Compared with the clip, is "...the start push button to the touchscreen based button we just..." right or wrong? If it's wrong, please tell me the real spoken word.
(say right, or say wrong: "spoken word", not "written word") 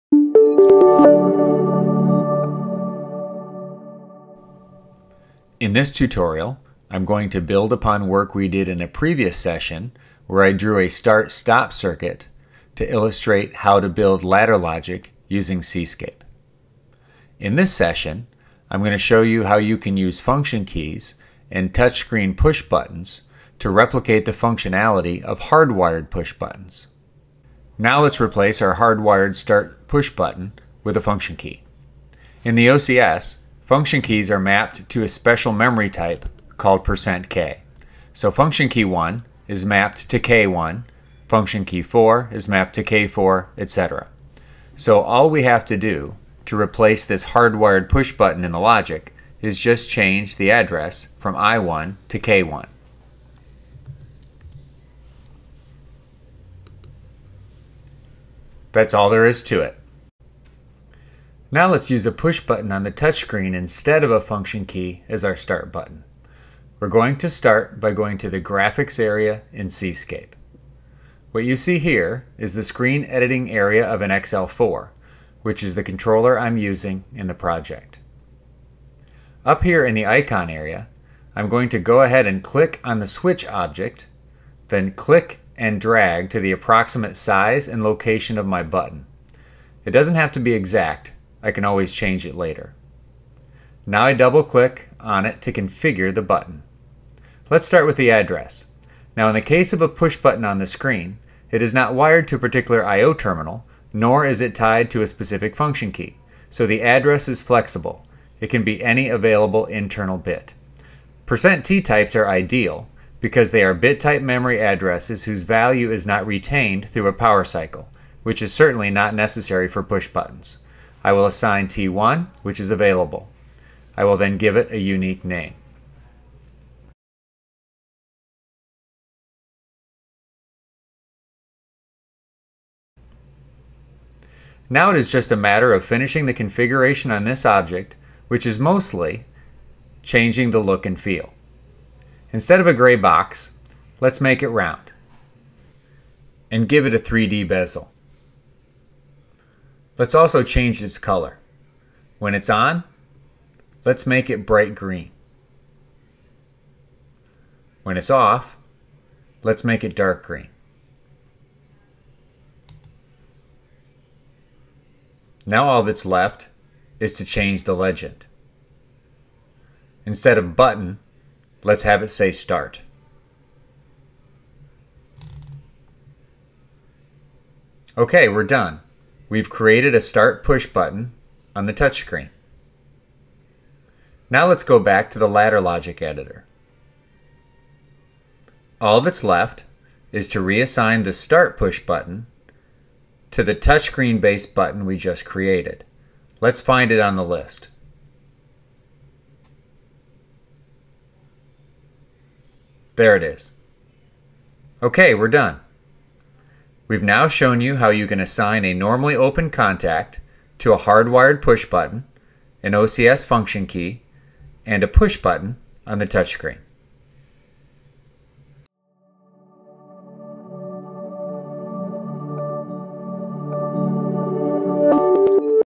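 right.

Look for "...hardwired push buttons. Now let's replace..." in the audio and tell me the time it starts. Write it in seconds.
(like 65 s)
25 s.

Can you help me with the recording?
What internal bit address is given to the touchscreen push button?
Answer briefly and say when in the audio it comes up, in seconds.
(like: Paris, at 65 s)
T1, at 121 s.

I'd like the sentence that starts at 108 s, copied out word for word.
It can be any available internal bit.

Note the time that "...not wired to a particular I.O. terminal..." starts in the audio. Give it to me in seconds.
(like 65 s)
101 s.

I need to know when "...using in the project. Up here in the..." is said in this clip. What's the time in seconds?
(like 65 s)
76 s.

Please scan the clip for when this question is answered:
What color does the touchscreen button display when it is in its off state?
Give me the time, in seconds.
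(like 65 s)
159 s.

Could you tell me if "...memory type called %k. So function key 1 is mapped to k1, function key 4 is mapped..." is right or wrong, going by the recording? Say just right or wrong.
right.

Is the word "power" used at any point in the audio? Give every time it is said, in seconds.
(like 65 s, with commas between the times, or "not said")
117 s.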